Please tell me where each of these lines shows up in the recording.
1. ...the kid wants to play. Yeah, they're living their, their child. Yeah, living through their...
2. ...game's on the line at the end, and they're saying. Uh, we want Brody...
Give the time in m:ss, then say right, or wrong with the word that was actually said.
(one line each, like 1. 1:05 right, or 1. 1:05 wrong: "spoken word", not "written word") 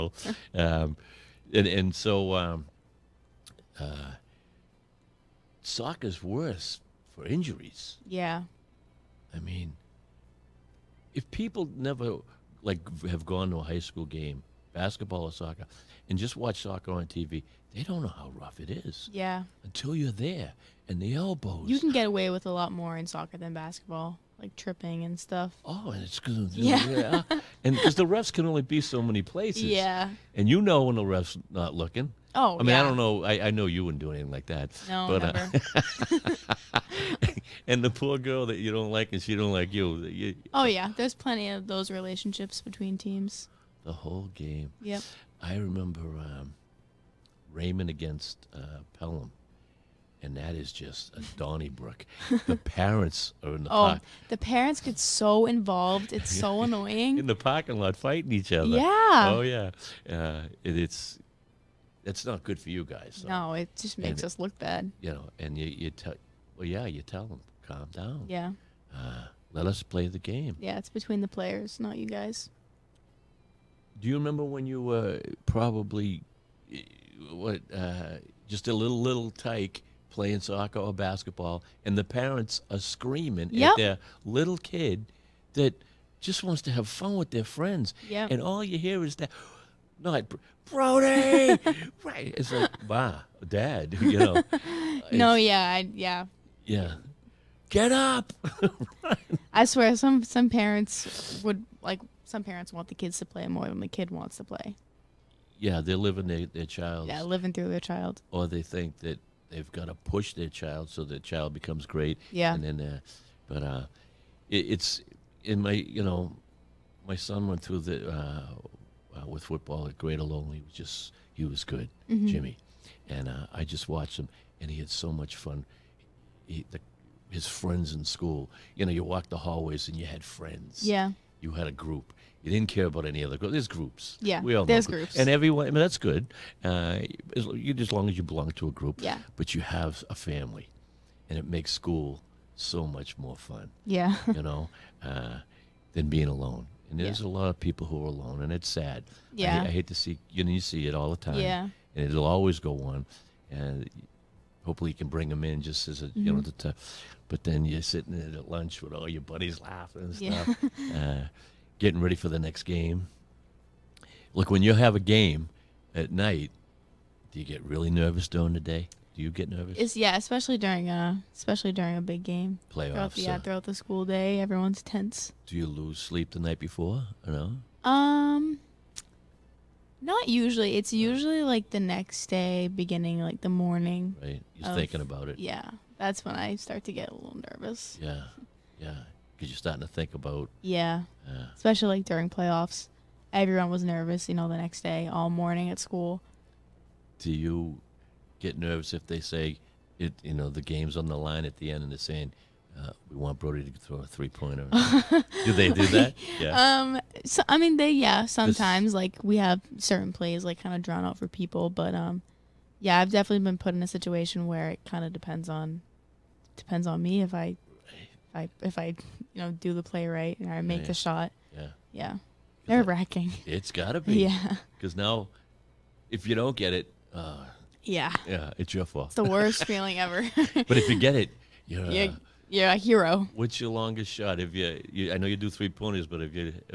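1. 1:43 right
2. 3:20 right.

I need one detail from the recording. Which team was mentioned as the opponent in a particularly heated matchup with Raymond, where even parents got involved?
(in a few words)
Pelham.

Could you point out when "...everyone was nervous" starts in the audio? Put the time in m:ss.
3:13.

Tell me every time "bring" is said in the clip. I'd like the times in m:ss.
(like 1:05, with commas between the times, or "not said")
2:35.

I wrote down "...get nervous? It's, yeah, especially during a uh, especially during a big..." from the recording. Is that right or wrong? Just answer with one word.
right.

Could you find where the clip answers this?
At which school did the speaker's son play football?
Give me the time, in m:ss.
1:59.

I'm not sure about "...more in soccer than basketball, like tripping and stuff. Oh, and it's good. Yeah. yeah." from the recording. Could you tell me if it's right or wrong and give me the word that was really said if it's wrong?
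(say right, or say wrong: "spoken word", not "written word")
right.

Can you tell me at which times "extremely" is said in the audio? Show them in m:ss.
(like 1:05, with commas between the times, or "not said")
not said.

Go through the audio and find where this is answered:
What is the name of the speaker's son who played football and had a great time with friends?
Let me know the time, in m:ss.
2:02.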